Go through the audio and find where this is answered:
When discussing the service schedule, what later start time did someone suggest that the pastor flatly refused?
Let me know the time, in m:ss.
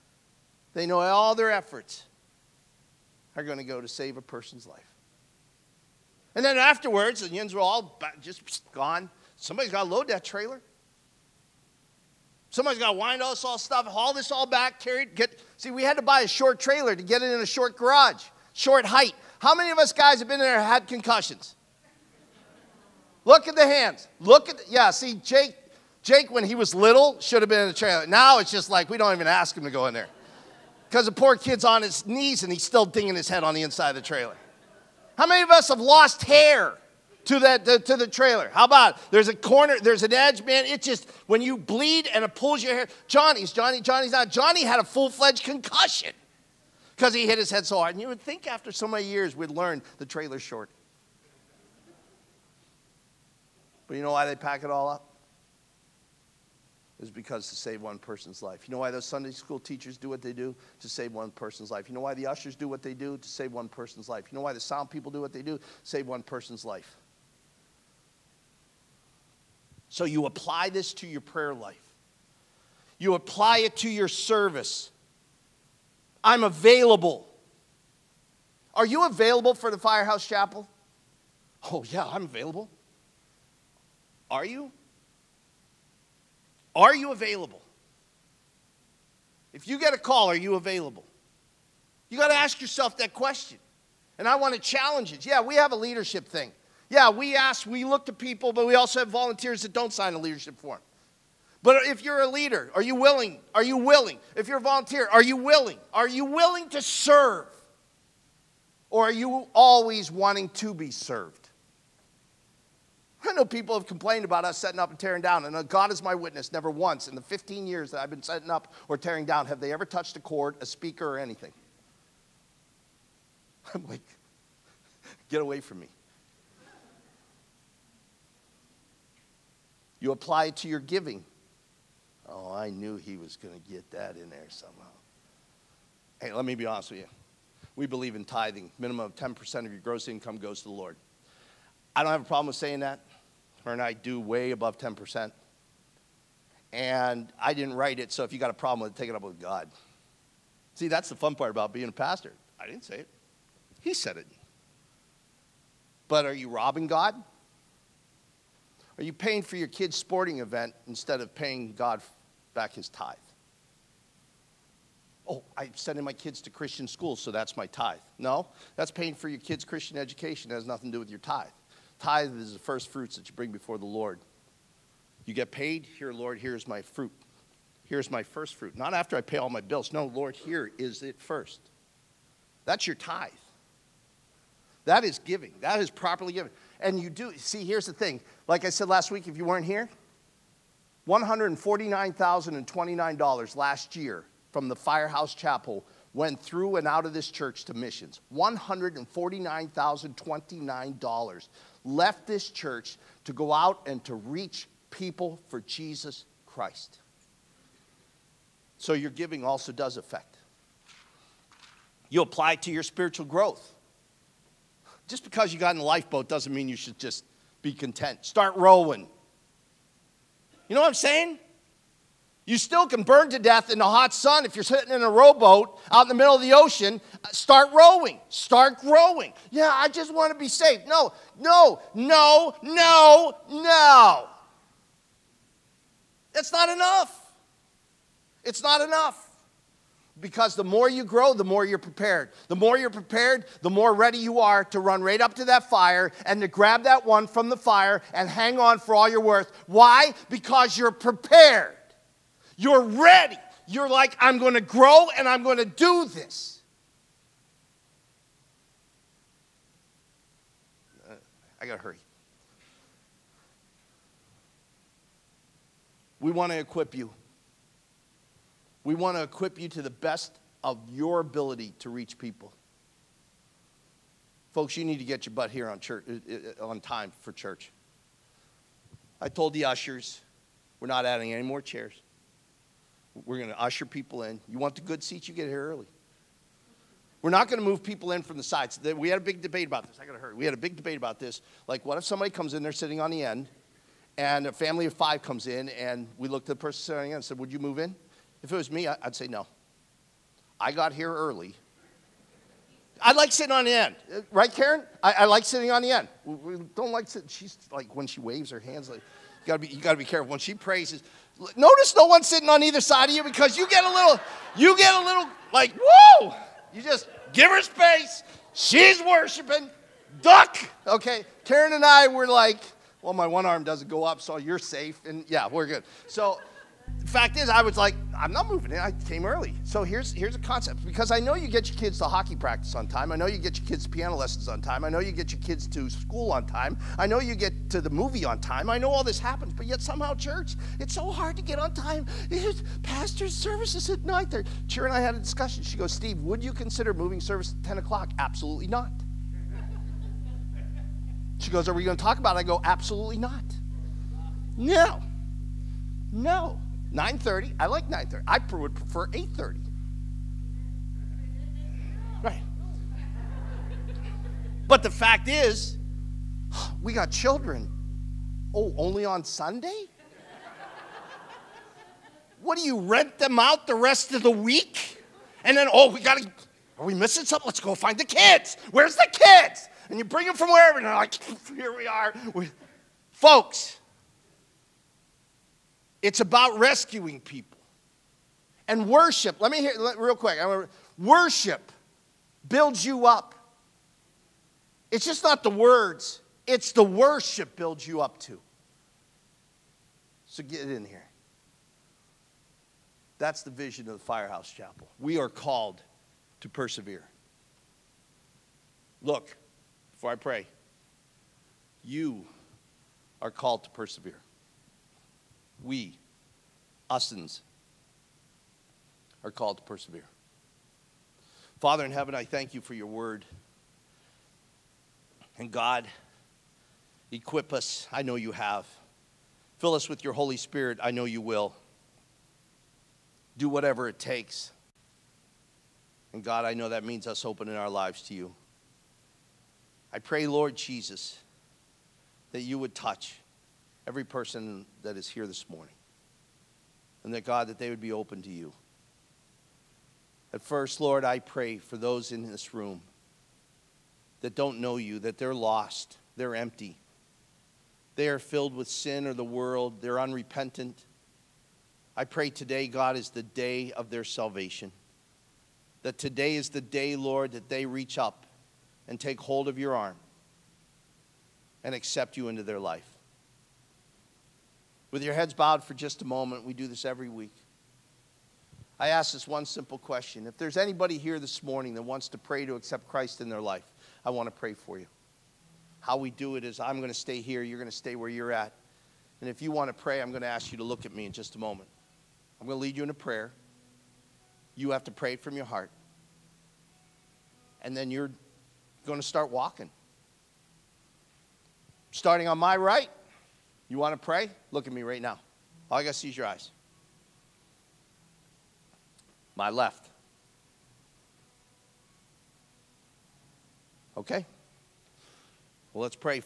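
5:47.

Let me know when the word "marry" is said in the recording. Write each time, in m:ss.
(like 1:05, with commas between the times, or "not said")
not said.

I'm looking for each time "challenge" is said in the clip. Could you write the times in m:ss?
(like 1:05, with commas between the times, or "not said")
1:34.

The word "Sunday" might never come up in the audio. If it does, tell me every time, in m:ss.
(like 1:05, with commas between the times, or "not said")
0:59, 6:09.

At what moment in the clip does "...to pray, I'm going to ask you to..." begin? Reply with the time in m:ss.
8:09.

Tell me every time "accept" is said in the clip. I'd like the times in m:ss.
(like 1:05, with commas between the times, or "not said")
7:51, 8:02.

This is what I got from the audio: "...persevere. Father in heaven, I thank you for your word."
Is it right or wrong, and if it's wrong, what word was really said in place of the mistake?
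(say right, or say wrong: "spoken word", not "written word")
right.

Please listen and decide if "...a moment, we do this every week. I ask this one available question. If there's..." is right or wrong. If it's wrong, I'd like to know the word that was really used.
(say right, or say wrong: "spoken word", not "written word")
wrong: "simple", not "available".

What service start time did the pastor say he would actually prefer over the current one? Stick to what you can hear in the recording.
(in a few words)
8:30.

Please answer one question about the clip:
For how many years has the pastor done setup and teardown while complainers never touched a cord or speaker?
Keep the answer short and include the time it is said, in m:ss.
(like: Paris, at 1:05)
15, at 1:57.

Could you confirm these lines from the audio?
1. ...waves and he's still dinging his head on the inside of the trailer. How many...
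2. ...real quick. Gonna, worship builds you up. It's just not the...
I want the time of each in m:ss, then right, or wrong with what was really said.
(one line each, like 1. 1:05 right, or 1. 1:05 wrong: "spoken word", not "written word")
1. 0:32 wrong: "knees", not "waves"
2. 6:29 right.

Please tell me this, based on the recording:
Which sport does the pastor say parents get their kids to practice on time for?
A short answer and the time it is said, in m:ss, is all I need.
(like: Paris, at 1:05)
Hockey, at 5:32.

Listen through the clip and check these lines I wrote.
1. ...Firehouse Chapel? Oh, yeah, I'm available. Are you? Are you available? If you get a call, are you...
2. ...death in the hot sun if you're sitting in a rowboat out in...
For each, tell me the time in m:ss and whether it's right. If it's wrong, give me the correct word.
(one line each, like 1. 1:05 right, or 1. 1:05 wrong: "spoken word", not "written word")
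1. 1:19 right
2. 3:43 right.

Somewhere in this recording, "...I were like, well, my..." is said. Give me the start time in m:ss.
5:21.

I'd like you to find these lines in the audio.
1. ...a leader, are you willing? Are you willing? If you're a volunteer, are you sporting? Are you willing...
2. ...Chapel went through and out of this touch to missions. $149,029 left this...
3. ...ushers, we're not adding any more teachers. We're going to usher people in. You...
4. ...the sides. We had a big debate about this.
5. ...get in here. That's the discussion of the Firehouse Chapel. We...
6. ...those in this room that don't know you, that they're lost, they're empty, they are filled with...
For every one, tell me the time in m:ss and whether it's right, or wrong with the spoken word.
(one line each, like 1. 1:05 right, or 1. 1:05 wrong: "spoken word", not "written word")
1. 1:42 wrong: "willing", not "sporting"
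2. 3:15 wrong: "church", not "touch"
3. 4:39 wrong: "chairs", not "teachers"
4. 4:48 right
5. 6:40 wrong: "vision", not "discussion"
6. 7:31 right.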